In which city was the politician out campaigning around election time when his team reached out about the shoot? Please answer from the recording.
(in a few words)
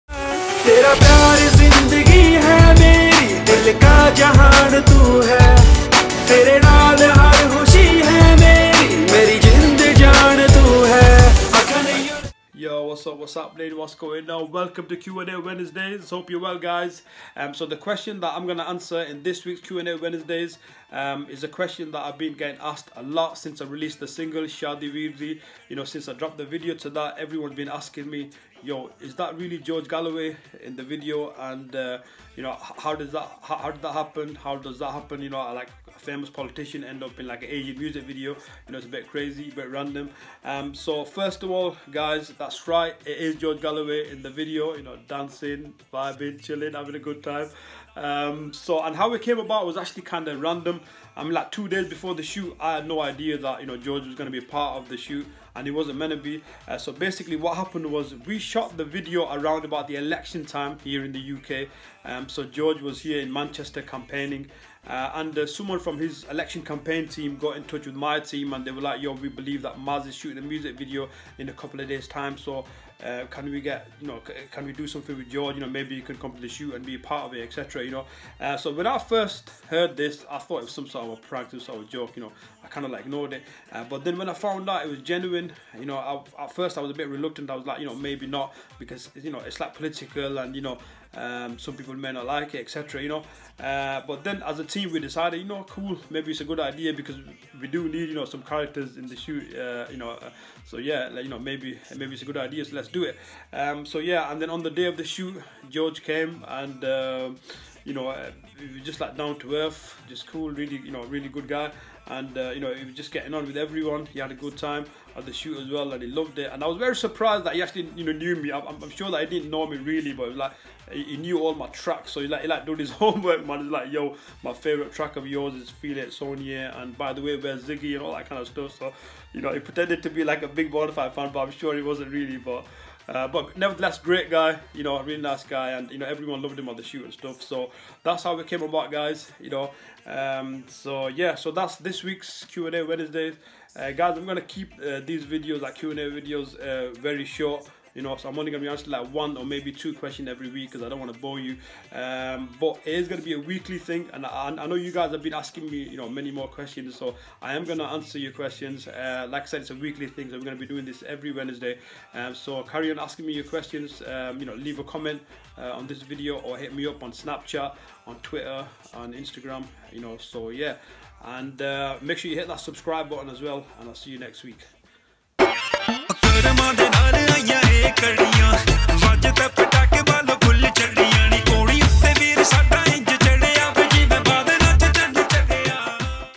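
Manchester.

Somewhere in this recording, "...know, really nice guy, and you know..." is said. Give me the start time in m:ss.
2:14.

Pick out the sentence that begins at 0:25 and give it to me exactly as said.
You know, since I dropped the video to that, everyone's been asking me, yo, is that really George Galloway in the video?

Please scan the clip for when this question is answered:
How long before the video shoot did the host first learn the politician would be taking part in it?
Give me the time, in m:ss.
0:51.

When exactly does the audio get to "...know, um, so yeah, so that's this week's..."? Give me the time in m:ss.
2:19.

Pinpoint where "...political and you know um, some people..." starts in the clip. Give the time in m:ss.
1:29.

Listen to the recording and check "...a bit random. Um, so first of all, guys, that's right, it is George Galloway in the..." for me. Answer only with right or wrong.
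right.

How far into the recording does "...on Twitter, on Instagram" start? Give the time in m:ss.
2:48.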